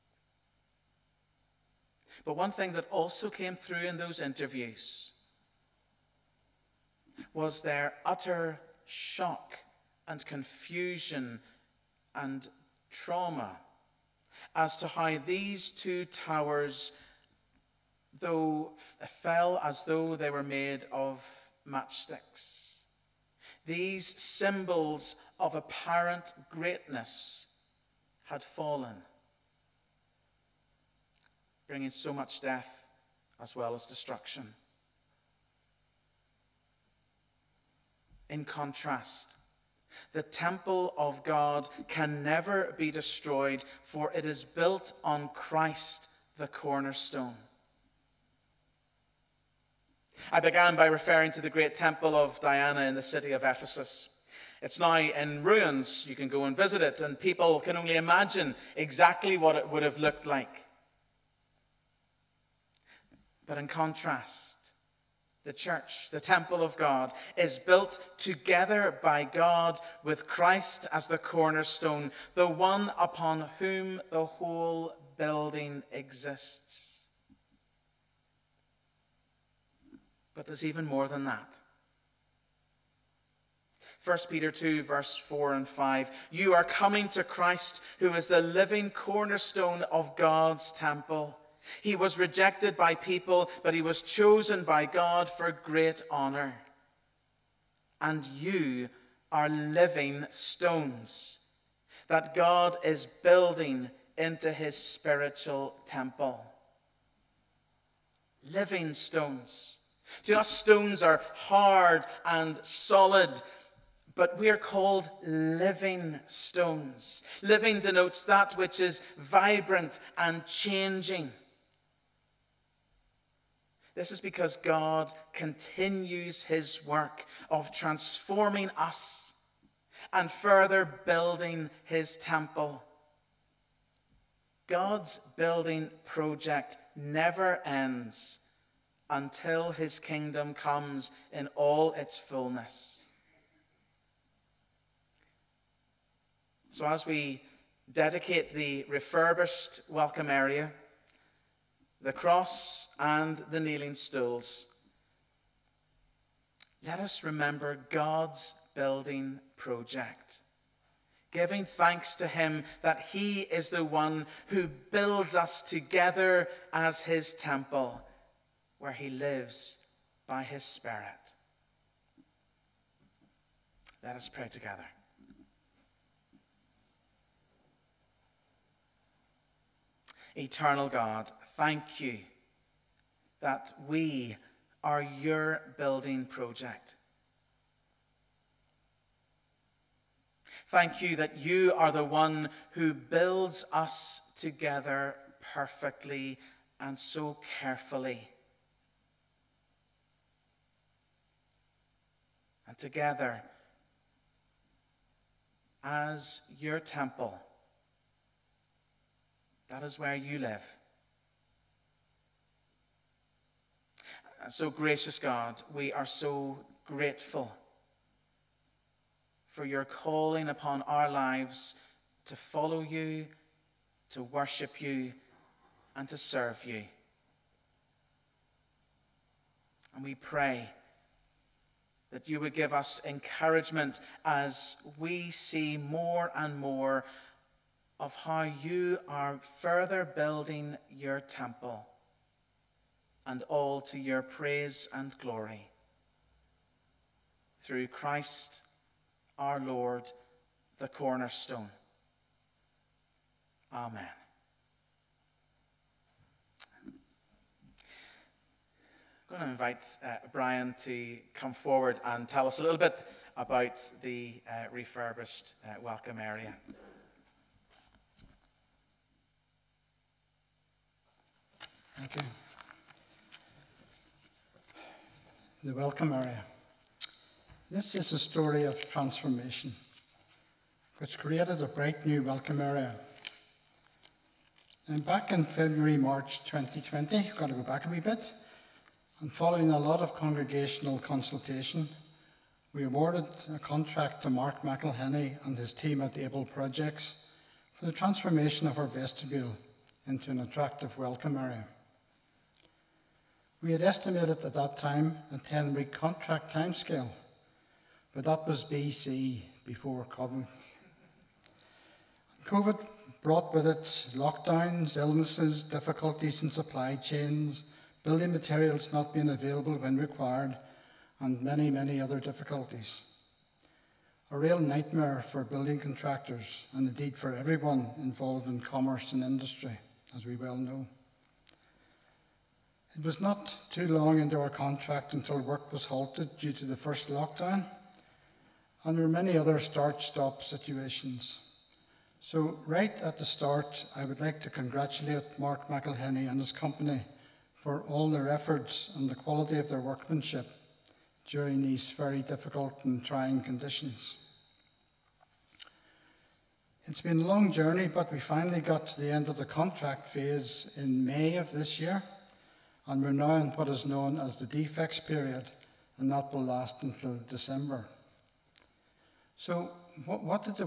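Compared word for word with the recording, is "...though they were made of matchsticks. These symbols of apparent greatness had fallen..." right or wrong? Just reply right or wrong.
right.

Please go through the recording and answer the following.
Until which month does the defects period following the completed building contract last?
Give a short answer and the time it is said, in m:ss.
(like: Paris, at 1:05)
December, at 6:07.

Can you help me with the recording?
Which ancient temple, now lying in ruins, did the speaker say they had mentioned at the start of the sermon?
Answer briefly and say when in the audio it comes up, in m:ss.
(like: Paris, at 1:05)
Temple of Diana, at 0:51.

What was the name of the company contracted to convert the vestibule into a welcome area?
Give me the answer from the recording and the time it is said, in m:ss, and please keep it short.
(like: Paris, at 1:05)
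Able Projects, at 4:56.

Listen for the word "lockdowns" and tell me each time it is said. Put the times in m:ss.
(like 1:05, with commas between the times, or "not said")
5:14, 5:37.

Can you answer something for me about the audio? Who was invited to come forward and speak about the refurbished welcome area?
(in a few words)
Brian.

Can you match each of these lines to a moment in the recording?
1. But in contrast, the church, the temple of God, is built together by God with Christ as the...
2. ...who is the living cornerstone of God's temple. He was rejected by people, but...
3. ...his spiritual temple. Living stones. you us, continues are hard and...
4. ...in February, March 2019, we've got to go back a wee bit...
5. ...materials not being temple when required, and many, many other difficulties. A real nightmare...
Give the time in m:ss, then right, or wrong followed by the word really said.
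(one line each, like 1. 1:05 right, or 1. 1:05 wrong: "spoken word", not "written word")
1. 1:03 right
2. 1:27 right
3. 1:44 wrong: "stones", not "continues"
4. 4:45 wrong: "2020", not "2019"
5. 5:18 wrong: "available", not "temple".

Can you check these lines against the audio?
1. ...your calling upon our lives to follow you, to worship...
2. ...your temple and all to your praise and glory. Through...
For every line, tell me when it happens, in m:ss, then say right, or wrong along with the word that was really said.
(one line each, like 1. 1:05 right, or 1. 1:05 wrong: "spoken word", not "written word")
1. 3:39 right
2. 4:00 right.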